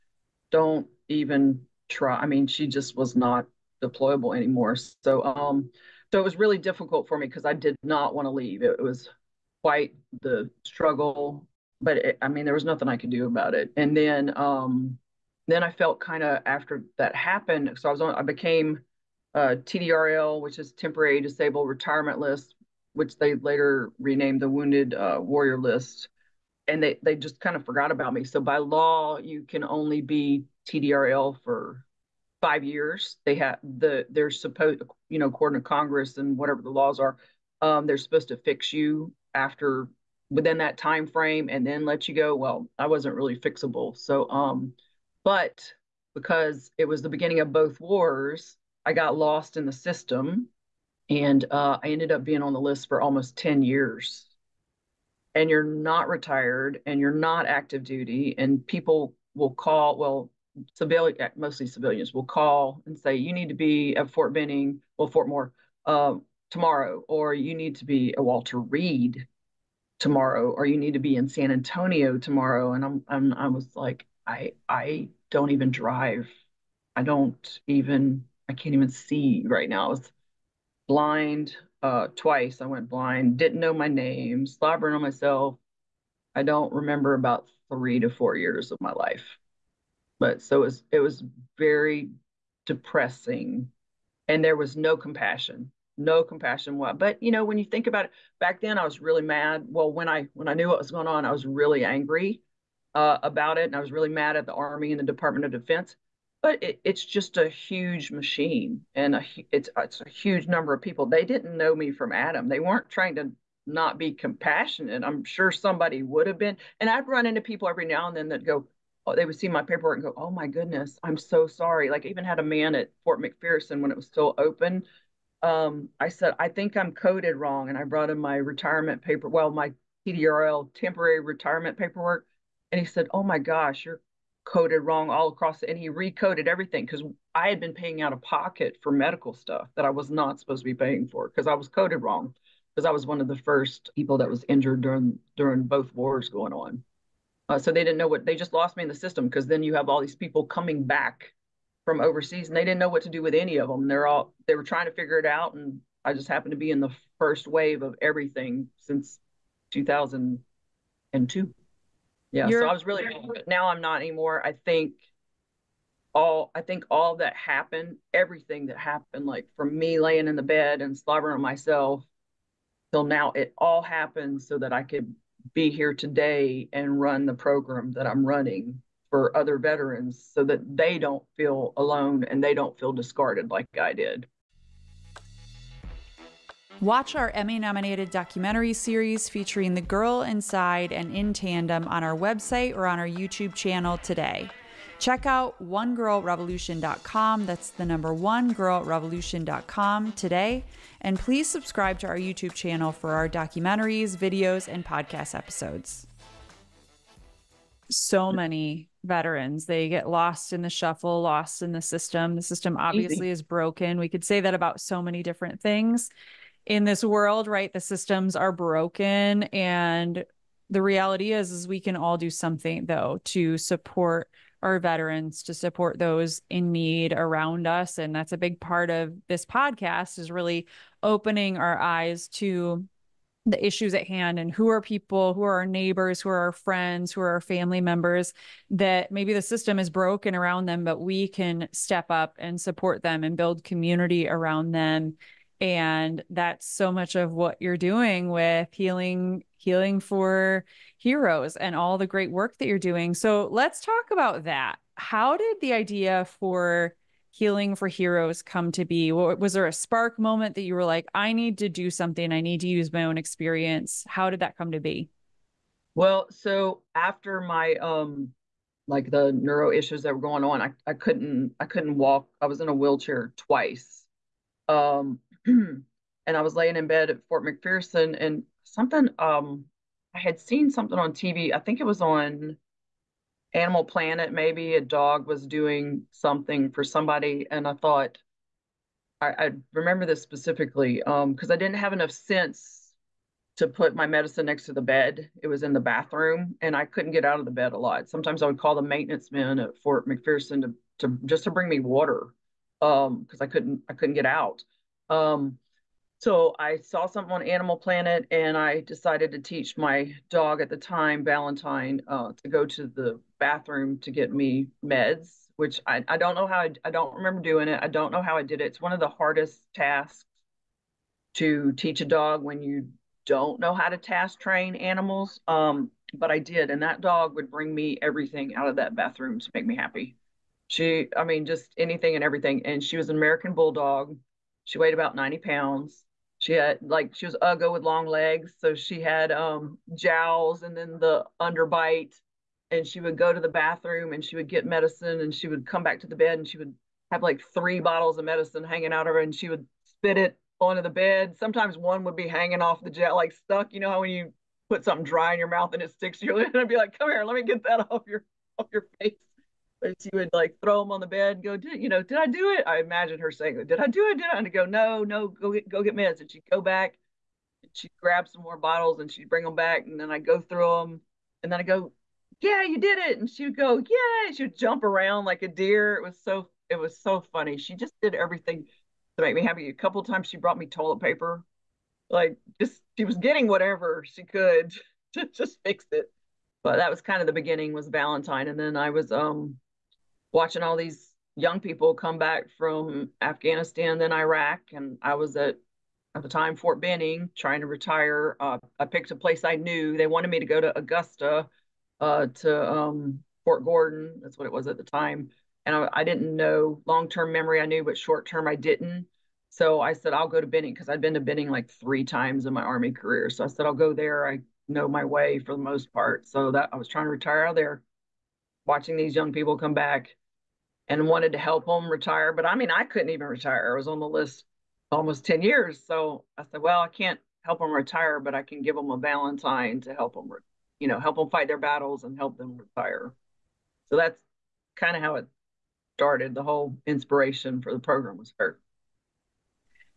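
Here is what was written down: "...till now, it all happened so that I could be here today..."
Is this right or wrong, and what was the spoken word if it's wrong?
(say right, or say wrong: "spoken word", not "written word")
right.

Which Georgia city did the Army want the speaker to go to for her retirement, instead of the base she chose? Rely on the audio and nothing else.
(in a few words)
Augusta.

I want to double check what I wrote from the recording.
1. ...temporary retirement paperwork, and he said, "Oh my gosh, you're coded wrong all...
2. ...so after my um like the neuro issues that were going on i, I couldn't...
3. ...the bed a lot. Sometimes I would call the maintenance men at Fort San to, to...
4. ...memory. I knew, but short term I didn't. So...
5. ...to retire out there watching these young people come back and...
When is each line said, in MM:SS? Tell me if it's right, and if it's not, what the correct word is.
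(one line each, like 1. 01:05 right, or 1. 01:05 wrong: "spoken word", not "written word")
1. 02:10 right
2. 04:26 right
3. 04:57 wrong: "McPherson", not "San"
4. 06:47 right
5. 06:57 right.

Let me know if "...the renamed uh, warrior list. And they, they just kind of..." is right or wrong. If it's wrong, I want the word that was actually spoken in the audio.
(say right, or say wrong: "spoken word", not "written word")
wrong: "wounded", not "renamed".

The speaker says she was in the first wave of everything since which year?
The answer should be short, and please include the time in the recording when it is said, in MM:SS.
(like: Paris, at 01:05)
2002, at 02:39.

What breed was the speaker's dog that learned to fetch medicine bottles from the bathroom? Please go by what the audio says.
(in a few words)
American Bulldog.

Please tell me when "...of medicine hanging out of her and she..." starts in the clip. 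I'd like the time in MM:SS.
05:48.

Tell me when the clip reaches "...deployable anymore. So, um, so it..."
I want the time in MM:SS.
00:03.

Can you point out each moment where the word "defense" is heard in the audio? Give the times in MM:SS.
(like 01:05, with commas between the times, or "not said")
01:45.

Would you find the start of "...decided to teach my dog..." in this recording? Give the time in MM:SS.
05:08.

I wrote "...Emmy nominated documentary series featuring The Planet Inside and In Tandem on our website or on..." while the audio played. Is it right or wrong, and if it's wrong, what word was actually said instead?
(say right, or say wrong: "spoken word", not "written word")
wrong: "Girl", not "Planet".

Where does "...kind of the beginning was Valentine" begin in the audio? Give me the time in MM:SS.
06:26.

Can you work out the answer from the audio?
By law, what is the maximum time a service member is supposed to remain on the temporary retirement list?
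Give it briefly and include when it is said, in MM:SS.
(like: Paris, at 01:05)
5 years, at 00:32.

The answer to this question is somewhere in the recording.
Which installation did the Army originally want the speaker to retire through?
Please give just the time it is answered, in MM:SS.
06:43.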